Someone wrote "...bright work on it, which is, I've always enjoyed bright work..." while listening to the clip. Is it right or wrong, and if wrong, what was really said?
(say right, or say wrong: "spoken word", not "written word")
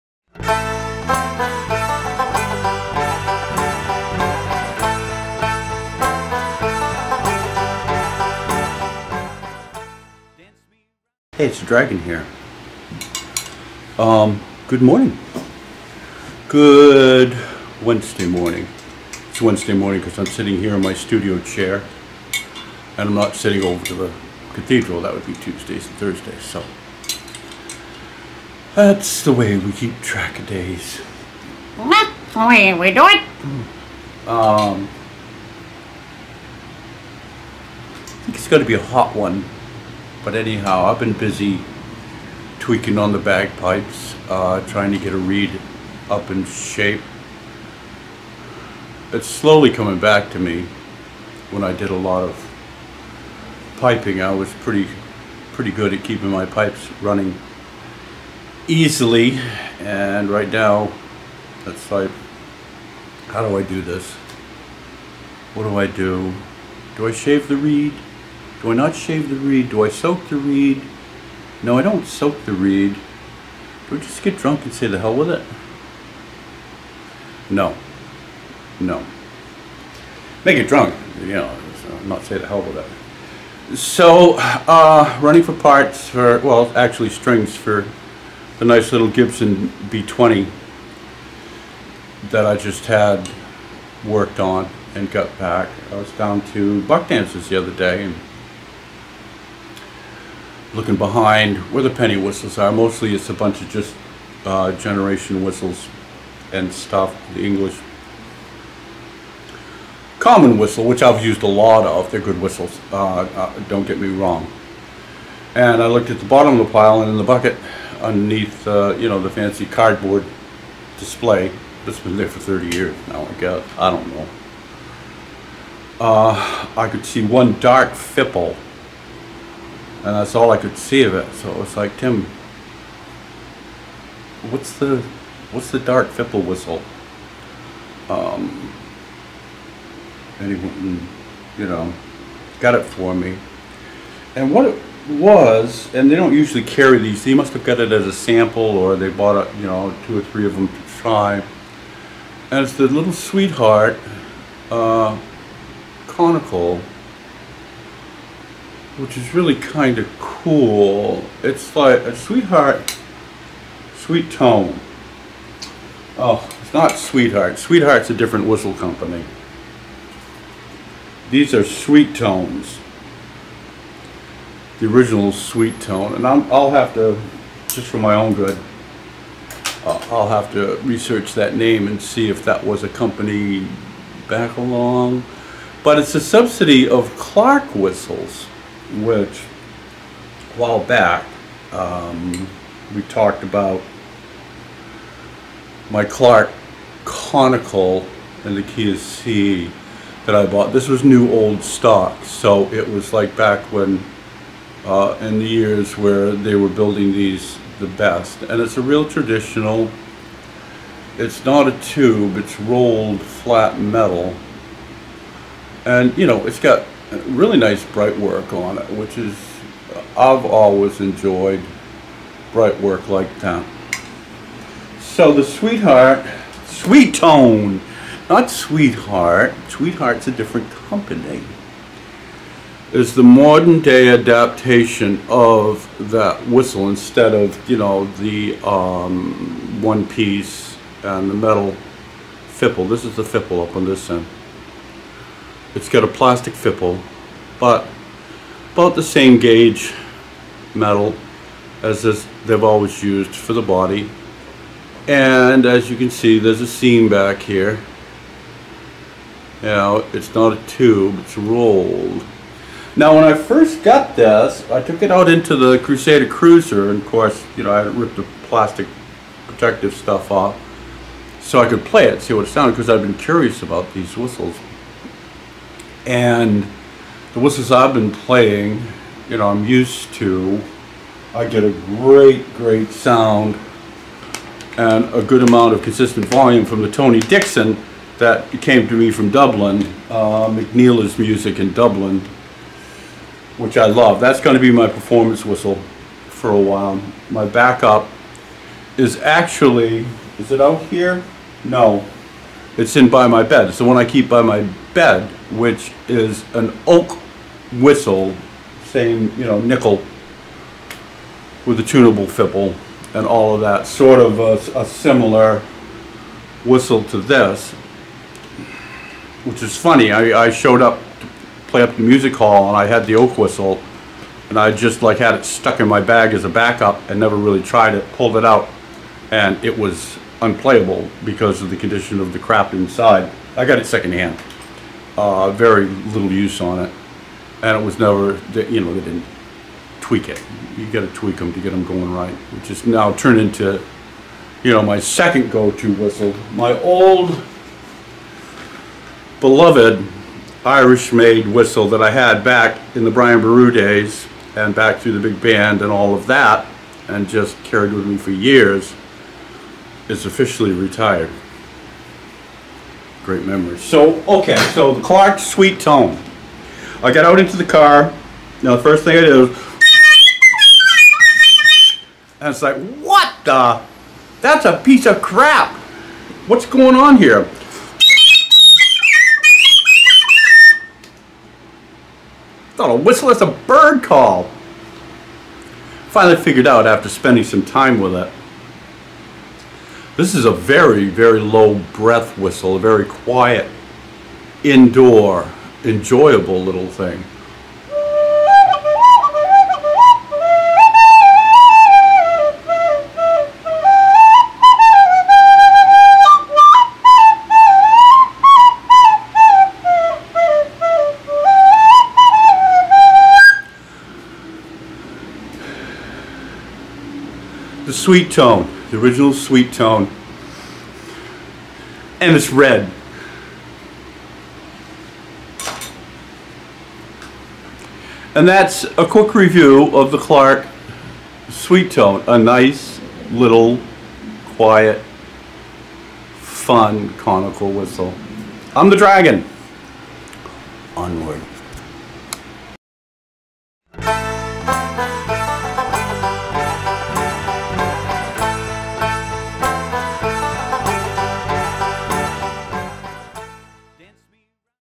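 right.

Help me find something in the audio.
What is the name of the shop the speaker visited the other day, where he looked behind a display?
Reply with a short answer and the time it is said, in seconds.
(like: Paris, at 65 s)
Buck Dances, at 96 s.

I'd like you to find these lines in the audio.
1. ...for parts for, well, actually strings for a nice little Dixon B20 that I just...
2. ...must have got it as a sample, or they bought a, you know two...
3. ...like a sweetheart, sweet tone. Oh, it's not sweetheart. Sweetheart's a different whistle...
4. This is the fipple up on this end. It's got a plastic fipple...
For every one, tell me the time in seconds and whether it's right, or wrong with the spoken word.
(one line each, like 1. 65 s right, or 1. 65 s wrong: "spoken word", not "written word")
1. 85 s wrong: "Gibson", not "Dixon"
2. 147 s right
3. 161 s right
4. 242 s right.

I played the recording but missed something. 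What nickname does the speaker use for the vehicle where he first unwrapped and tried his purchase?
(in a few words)
Crusader Cruiser.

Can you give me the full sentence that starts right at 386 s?
Finally figured out after spending some time with it.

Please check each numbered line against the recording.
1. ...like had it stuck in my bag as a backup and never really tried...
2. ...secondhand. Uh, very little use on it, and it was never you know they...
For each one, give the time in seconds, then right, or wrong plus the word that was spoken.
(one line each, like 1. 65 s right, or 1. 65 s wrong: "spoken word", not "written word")
1. 325 s right
2. 333 s right.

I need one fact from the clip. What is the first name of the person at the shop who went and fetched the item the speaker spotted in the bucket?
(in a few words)
Tim.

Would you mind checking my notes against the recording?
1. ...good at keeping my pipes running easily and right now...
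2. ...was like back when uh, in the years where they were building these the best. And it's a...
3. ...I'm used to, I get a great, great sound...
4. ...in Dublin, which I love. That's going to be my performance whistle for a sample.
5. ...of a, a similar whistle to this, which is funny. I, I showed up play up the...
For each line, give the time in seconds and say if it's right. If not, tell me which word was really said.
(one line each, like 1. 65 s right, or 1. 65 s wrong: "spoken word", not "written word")
1. 55 s right
2. 202 s right
3. 279 s right
4. 291 s wrong: "while", not "sample"
5. 314 s right.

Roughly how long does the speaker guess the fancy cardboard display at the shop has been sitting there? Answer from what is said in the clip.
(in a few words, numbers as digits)
30 years.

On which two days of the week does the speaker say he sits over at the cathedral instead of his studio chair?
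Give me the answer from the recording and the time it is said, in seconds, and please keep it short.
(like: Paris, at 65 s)
Tuesdays and Thursdays, at 25 s.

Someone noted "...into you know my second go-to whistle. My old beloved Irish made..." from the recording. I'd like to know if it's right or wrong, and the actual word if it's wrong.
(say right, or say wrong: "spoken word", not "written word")
right.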